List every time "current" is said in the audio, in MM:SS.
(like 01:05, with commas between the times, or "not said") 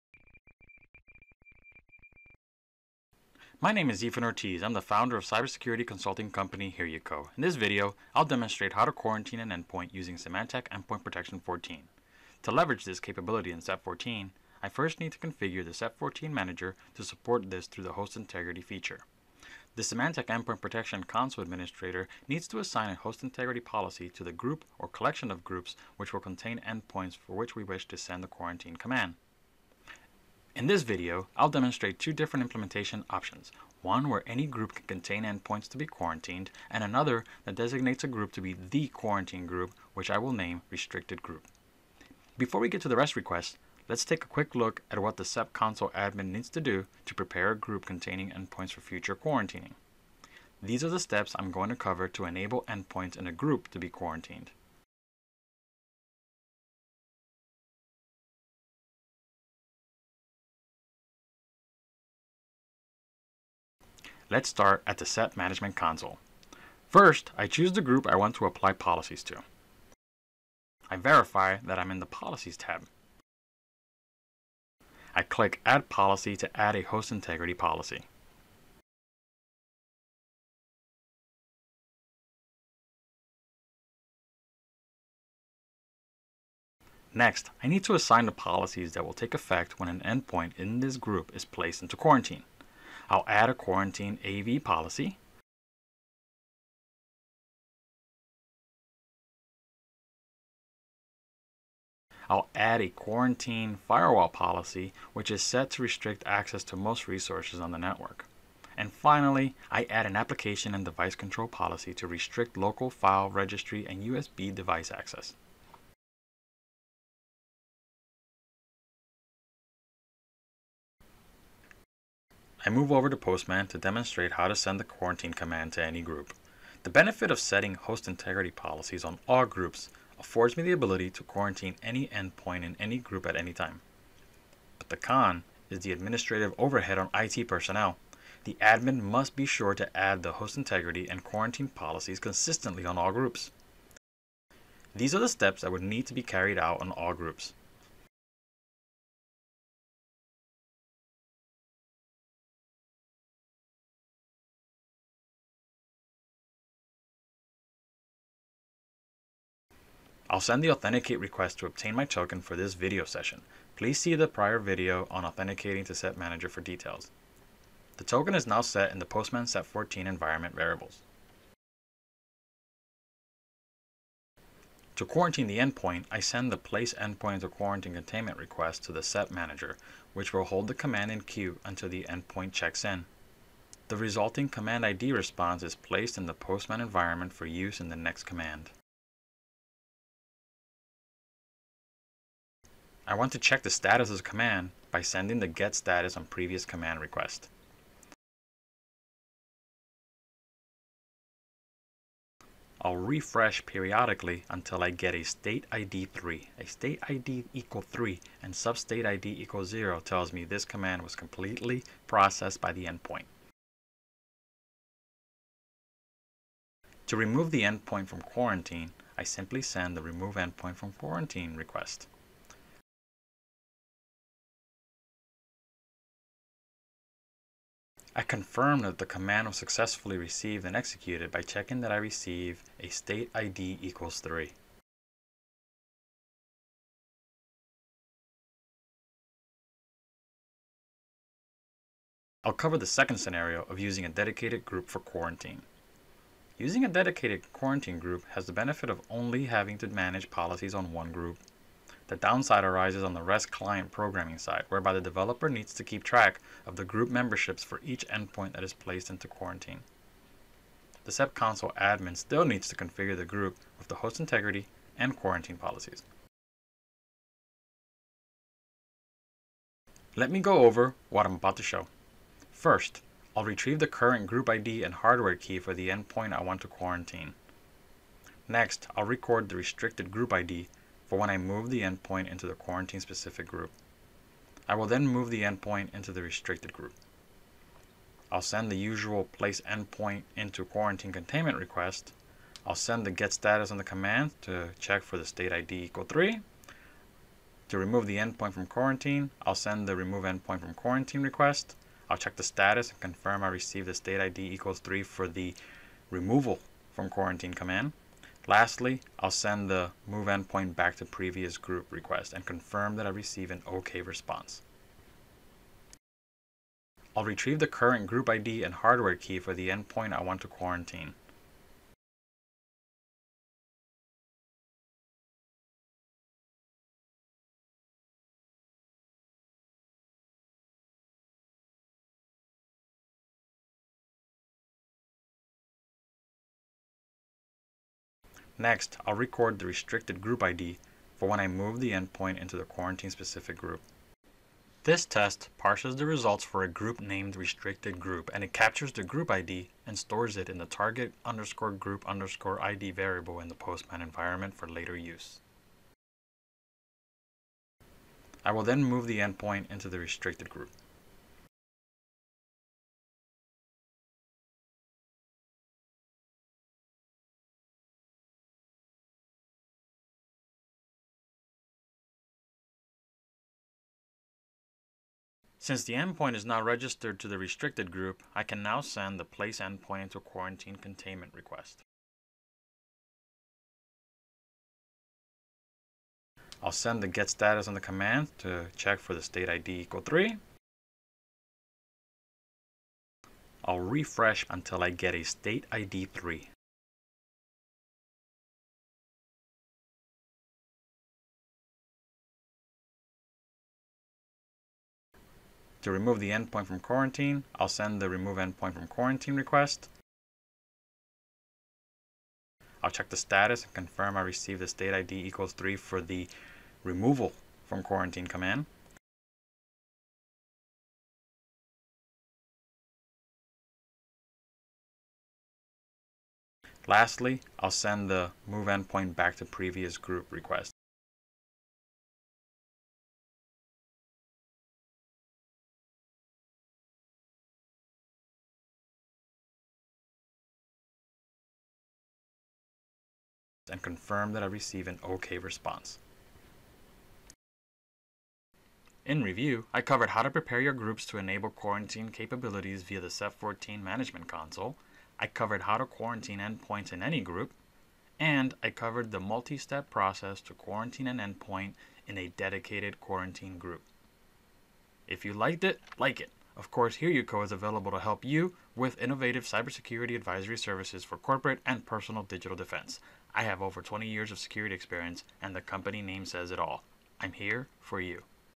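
04:33, 05:17.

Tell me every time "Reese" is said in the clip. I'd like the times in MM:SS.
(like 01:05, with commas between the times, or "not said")
not said.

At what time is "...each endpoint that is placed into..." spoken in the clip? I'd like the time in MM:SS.
04:17.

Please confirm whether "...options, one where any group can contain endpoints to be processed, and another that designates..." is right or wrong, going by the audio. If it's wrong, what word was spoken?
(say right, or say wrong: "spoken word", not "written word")
wrong: "quarantined", not "processed".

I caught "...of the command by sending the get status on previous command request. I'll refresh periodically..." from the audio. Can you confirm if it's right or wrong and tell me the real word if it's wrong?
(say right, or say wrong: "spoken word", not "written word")
right.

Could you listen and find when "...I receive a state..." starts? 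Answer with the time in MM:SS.
03:51.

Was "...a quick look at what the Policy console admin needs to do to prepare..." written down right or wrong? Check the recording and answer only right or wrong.
wrong.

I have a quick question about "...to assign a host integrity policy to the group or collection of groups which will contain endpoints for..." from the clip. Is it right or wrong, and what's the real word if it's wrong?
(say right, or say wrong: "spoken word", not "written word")
right.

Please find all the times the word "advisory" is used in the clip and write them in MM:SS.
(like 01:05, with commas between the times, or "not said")
07:50.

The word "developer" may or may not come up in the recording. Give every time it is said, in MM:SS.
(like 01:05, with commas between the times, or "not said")
04:14.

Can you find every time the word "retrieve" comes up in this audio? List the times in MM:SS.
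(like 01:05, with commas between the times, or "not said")
04:33, 05:17.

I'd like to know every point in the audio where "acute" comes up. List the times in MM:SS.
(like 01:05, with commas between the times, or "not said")
not said.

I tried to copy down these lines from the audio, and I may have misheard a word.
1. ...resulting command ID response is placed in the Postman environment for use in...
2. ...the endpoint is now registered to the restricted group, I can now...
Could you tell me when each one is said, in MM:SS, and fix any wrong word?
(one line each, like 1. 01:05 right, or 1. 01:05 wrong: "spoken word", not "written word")
1. 03:03 right
2. 06:15 right.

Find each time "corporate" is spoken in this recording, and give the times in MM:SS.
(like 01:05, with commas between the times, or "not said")
07:51.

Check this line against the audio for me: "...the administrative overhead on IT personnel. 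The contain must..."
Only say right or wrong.
wrong.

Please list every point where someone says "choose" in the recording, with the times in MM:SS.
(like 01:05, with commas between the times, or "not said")
01:07.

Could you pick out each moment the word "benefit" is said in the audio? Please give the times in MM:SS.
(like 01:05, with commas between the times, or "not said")
02:06, 04:08.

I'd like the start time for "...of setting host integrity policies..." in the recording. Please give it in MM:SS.
02:07.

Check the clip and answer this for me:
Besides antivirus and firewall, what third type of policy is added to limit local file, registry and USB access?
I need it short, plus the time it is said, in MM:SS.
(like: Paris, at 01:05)
application and device control, at 01:50.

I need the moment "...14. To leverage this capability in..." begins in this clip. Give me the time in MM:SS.
00:11.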